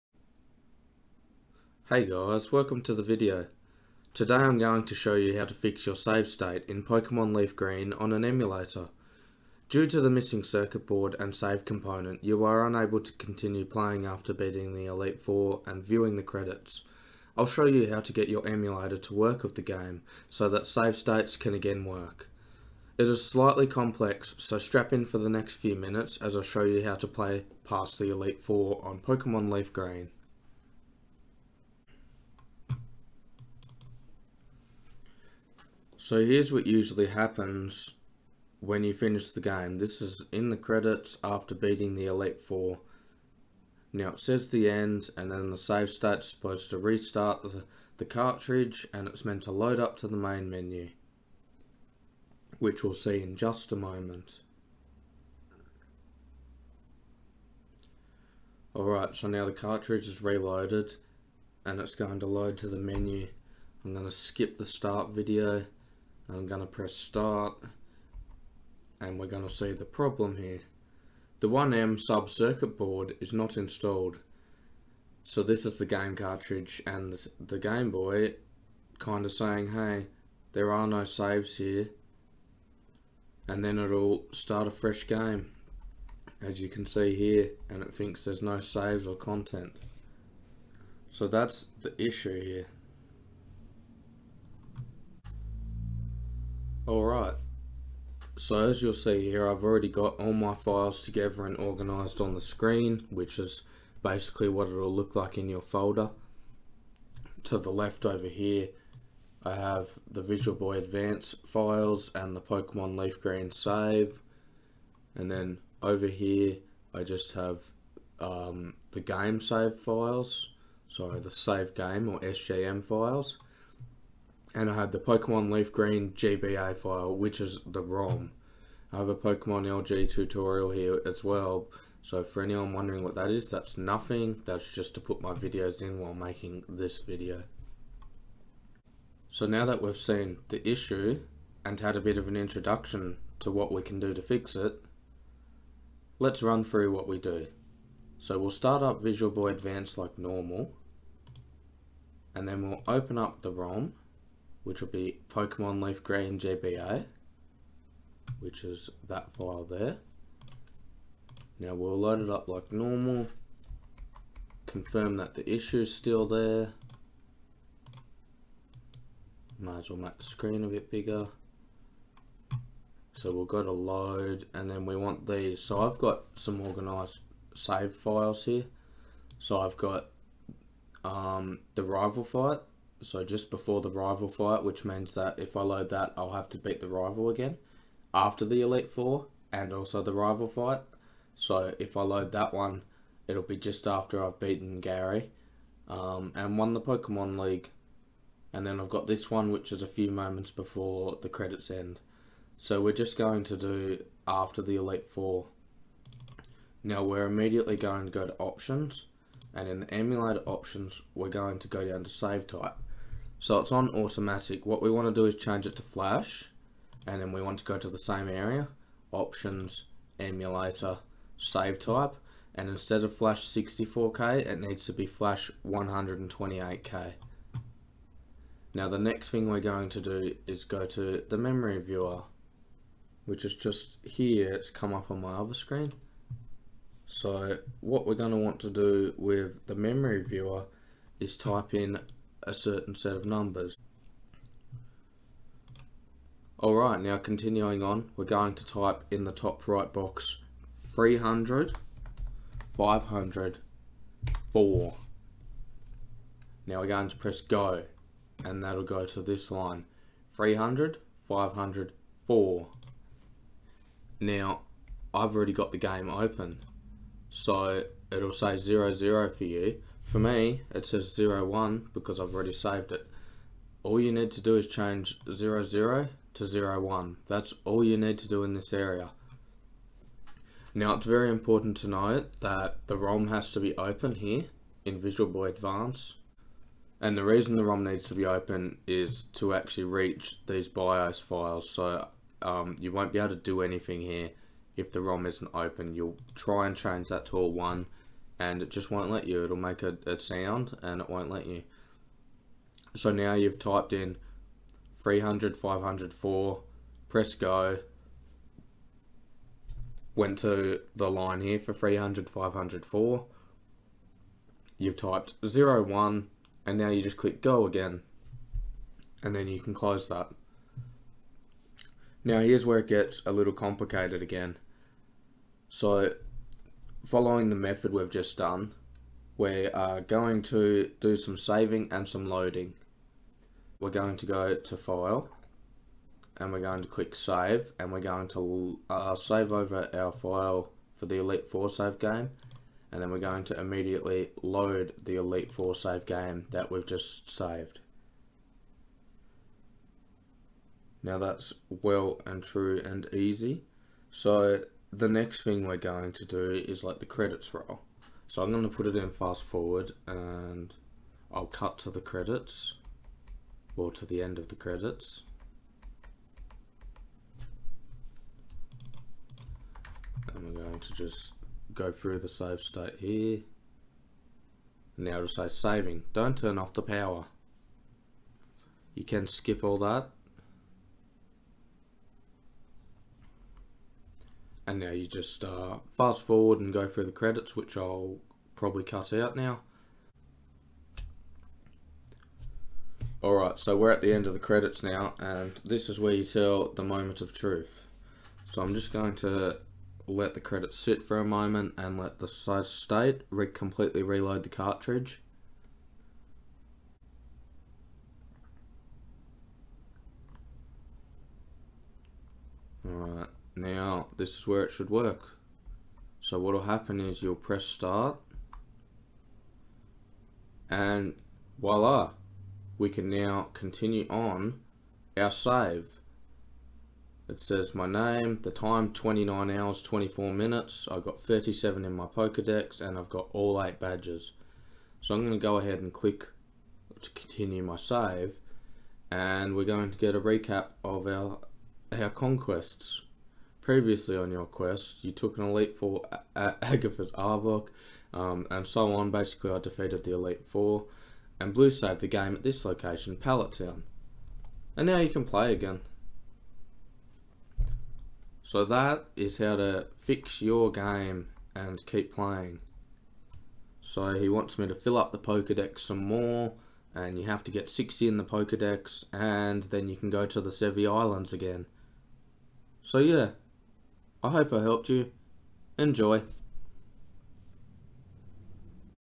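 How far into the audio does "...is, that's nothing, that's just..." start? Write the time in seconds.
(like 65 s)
133 s.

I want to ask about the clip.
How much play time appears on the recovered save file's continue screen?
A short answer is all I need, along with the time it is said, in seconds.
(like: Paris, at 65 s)
29 hours 24 minutes, at 428 s.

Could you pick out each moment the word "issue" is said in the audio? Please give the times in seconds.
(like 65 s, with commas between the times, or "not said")
92 s, 140 s, 165 s.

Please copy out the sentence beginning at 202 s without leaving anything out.
So we're just going to do after the Elite Four.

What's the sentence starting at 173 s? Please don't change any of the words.
So we'll go to load and then we want these.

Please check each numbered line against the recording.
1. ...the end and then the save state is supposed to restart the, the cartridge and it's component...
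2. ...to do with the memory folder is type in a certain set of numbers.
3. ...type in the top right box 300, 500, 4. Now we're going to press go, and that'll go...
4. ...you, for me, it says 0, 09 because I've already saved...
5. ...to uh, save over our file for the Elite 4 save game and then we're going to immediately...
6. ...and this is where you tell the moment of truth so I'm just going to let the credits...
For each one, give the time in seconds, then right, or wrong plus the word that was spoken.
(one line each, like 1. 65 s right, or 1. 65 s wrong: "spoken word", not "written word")
1. 44 s wrong: "meant", not "component"
2. 238 s wrong: "viewer", not "folder"
3. 248 s right
4. 269 s wrong: "01", not "09"
5. 338 s right
6. 395 s right.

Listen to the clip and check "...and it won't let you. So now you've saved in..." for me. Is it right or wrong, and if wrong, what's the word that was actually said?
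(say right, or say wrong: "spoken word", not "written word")
wrong: "typed", not "saved".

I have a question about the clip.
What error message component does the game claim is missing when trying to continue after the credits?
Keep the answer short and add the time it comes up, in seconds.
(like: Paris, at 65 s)
1M sub circuit board, at 71 s.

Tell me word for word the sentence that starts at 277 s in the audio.
That's all you need to do in this area.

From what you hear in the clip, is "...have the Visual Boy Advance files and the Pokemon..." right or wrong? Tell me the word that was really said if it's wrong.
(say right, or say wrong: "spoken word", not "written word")
right.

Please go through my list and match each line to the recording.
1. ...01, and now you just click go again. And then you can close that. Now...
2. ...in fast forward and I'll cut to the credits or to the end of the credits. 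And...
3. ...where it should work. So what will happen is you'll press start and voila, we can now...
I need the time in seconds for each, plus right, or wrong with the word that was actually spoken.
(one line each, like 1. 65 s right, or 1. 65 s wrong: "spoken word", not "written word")
1. 315 s right
2. 358 s right
3. 414 s right.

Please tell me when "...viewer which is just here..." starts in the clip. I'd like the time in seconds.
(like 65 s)
231 s.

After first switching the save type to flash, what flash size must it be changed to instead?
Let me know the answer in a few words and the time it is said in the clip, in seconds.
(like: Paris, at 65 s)
Flash 128k, at 225 s.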